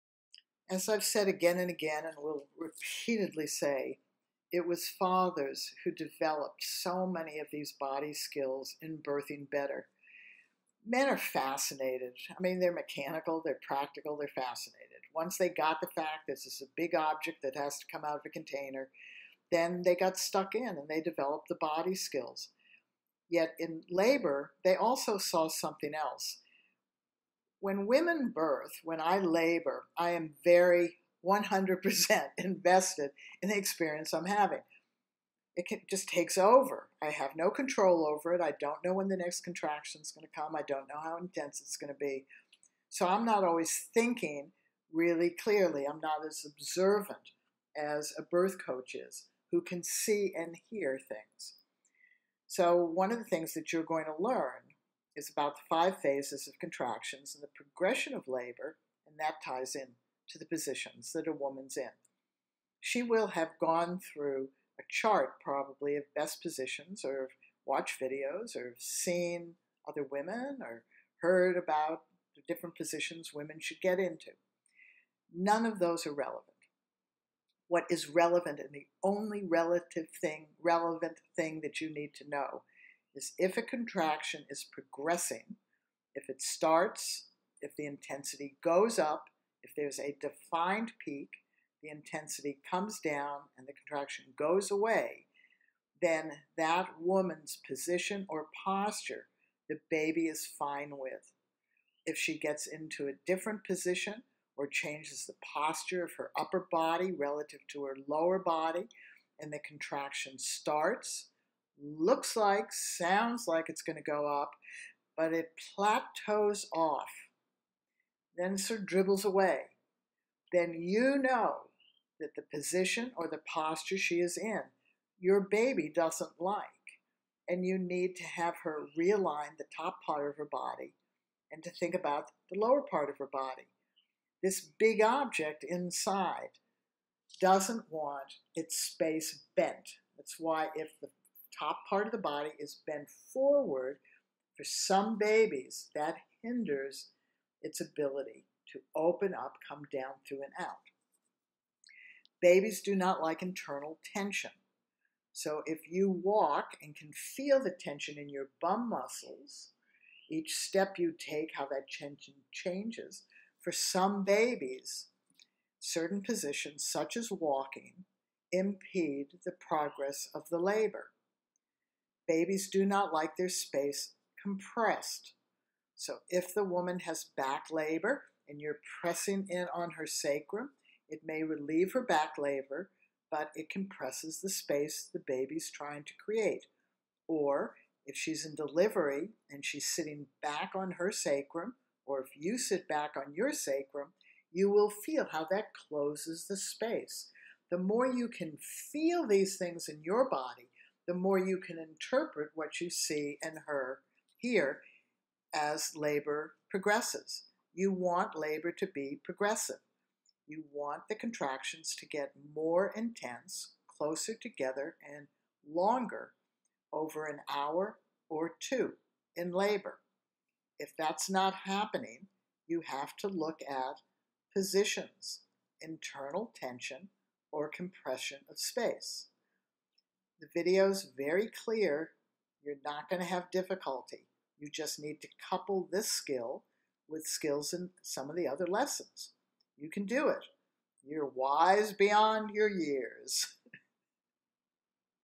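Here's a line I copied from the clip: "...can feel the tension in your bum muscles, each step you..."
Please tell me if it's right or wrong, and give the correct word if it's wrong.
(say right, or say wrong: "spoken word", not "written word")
right.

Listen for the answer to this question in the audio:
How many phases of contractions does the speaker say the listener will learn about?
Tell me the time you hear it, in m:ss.
0:55.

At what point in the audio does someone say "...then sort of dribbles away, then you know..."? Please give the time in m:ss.
1:58.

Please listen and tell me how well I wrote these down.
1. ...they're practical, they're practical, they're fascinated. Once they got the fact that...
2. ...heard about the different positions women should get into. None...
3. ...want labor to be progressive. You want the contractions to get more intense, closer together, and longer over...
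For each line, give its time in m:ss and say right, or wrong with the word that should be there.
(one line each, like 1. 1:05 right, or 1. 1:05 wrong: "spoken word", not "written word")
1. 0:12 wrong: "mechanical", not "practical"
2. 1:11 right
3. 3:27 right.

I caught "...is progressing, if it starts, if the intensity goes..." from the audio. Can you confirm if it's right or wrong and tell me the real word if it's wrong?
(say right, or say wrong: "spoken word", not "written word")
right.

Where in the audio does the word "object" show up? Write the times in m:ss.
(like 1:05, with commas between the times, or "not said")
0:16, 2:15.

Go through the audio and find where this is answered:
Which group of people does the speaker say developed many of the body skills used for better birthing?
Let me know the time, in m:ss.
0:04.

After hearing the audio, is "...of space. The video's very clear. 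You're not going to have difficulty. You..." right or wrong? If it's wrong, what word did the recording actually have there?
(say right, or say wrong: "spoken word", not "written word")
right.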